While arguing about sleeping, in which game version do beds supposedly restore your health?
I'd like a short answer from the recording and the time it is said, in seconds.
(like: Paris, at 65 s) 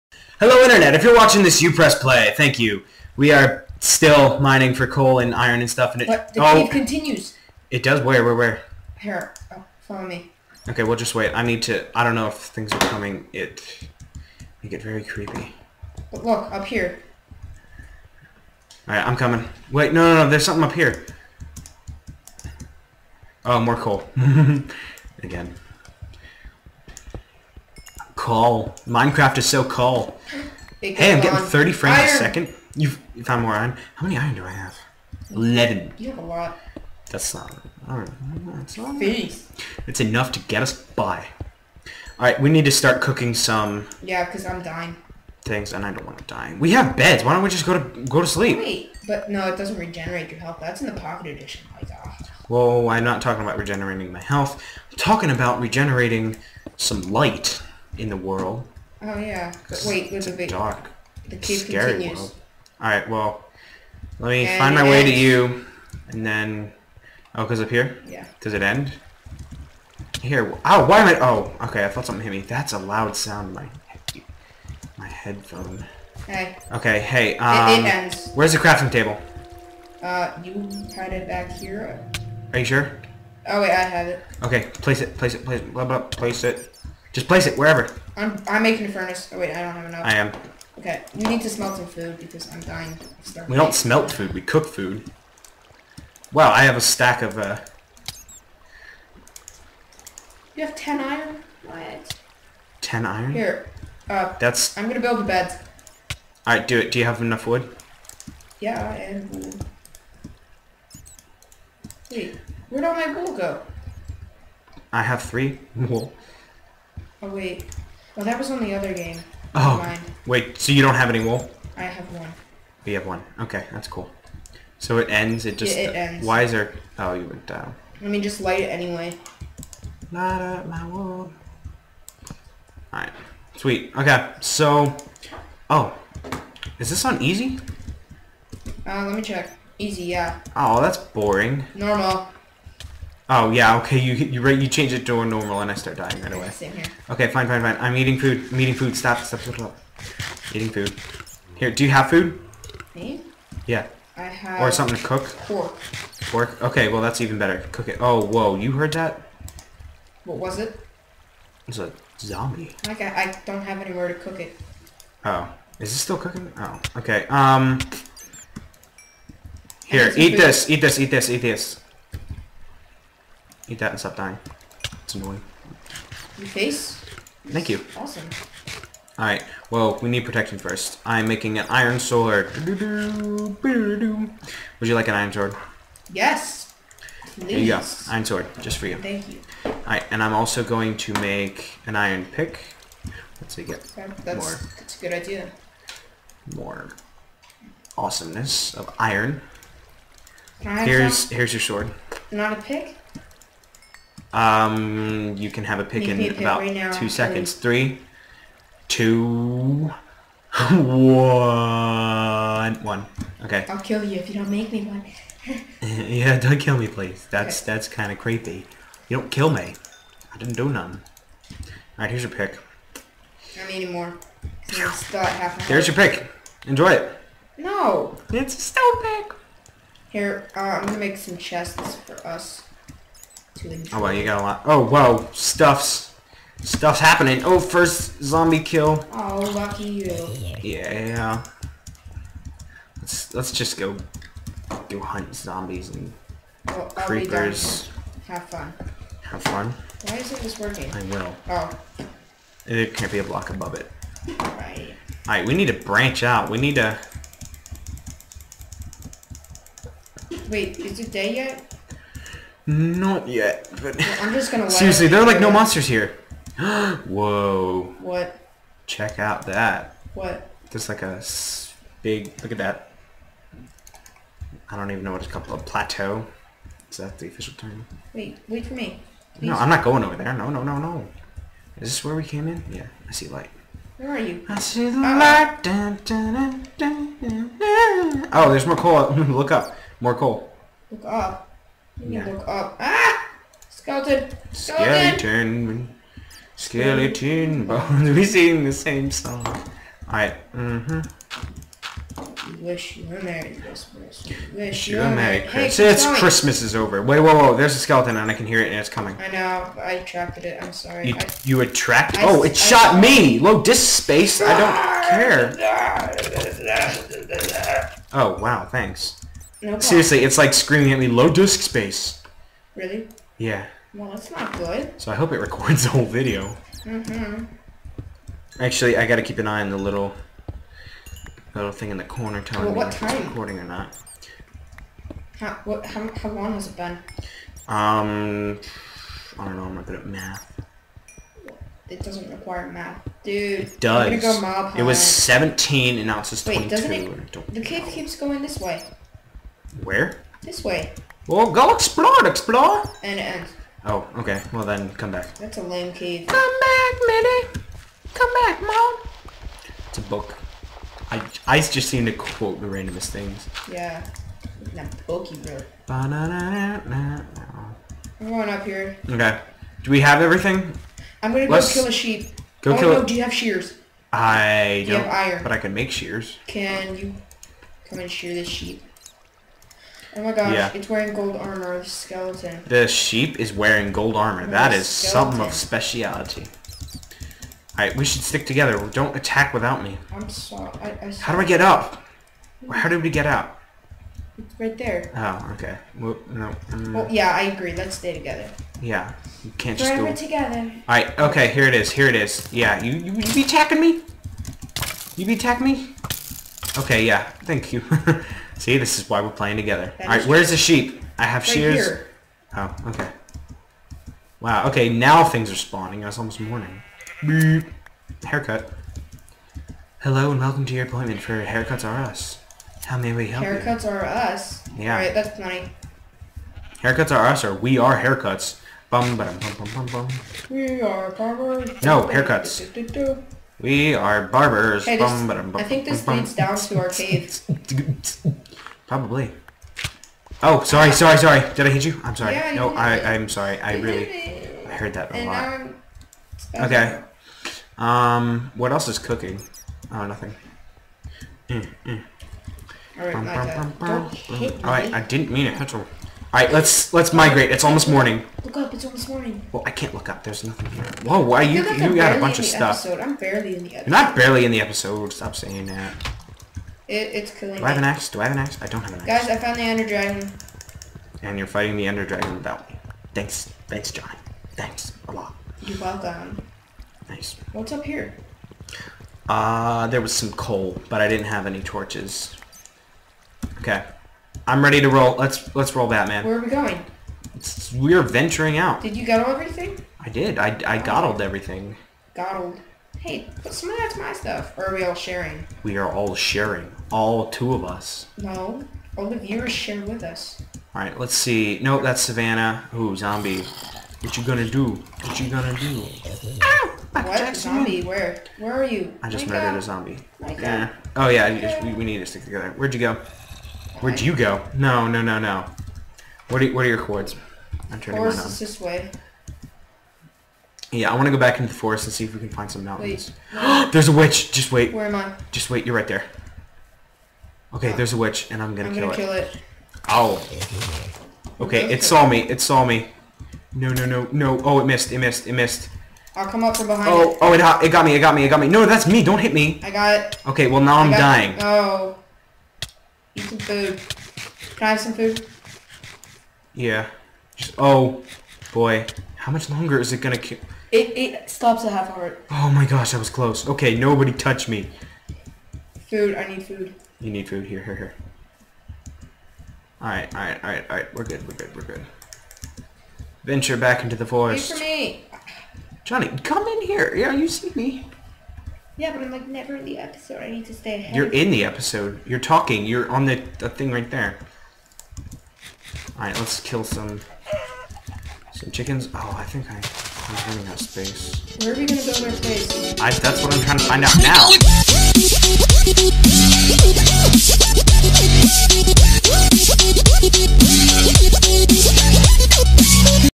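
pocket edition, at 51 s.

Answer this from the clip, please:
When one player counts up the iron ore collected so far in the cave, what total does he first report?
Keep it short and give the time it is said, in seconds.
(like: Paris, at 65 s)
11, at 35 s.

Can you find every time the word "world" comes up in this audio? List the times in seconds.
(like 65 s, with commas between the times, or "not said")
58 s, 62 s.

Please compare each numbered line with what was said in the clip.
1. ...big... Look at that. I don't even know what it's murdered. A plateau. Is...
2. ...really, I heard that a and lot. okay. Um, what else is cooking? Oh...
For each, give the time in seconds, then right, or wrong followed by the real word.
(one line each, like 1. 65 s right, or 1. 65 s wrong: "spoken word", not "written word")
1. 272 s wrong: "called", not "murdered"
2. 443 s right.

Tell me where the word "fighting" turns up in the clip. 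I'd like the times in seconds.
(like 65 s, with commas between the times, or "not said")
471 s.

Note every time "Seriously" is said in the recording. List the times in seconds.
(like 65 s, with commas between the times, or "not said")
264 s, 319 s.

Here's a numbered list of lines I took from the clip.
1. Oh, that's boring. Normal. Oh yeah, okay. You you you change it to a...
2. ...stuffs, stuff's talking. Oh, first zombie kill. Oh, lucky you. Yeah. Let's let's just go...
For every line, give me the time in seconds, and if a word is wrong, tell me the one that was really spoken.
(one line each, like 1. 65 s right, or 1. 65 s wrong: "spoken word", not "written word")
1. 140 s right
2. 235 s wrong: "happening", not "talking".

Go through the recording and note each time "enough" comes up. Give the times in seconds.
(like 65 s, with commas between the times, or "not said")
39 s, 89 s, 107 s.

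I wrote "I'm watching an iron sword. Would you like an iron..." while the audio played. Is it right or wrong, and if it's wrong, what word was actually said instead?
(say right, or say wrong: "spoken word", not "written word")
wrong: "making", not "watching".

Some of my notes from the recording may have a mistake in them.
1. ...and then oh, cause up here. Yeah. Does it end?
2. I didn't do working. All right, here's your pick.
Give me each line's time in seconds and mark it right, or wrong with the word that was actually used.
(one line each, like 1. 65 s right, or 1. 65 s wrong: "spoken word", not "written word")
1. 66 s right
2. 220 s wrong: "nothing", not "working".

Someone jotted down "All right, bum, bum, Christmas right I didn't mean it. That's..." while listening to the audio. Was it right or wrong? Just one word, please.
wrong.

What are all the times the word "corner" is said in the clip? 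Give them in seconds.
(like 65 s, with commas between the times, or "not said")
332 s.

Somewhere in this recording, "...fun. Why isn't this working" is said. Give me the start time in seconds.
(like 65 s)
249 s.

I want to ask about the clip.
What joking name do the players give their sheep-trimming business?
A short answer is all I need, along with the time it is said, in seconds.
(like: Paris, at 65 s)
Haircuts Are Us, at 426 s.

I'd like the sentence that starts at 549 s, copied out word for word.
How much longer is it gonna kill?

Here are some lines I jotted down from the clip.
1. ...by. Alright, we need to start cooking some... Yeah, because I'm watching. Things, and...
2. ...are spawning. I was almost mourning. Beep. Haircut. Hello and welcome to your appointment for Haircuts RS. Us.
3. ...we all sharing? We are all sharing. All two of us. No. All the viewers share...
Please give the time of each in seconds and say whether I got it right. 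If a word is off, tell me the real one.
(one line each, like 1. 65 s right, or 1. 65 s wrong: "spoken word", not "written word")
1. 40 s wrong: "dying", not "watching"
2. 415 s right
3. 494 s right.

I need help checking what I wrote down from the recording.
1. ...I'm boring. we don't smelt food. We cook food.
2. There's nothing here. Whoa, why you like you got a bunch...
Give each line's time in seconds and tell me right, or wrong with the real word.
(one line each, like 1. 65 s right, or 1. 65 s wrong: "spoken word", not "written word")
1. 92 s wrong: "dying", not "boring"
2. 460 s right.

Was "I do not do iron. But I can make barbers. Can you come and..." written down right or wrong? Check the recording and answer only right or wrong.
wrong.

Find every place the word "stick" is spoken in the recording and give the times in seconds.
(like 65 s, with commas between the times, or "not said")
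388 s, 512 s.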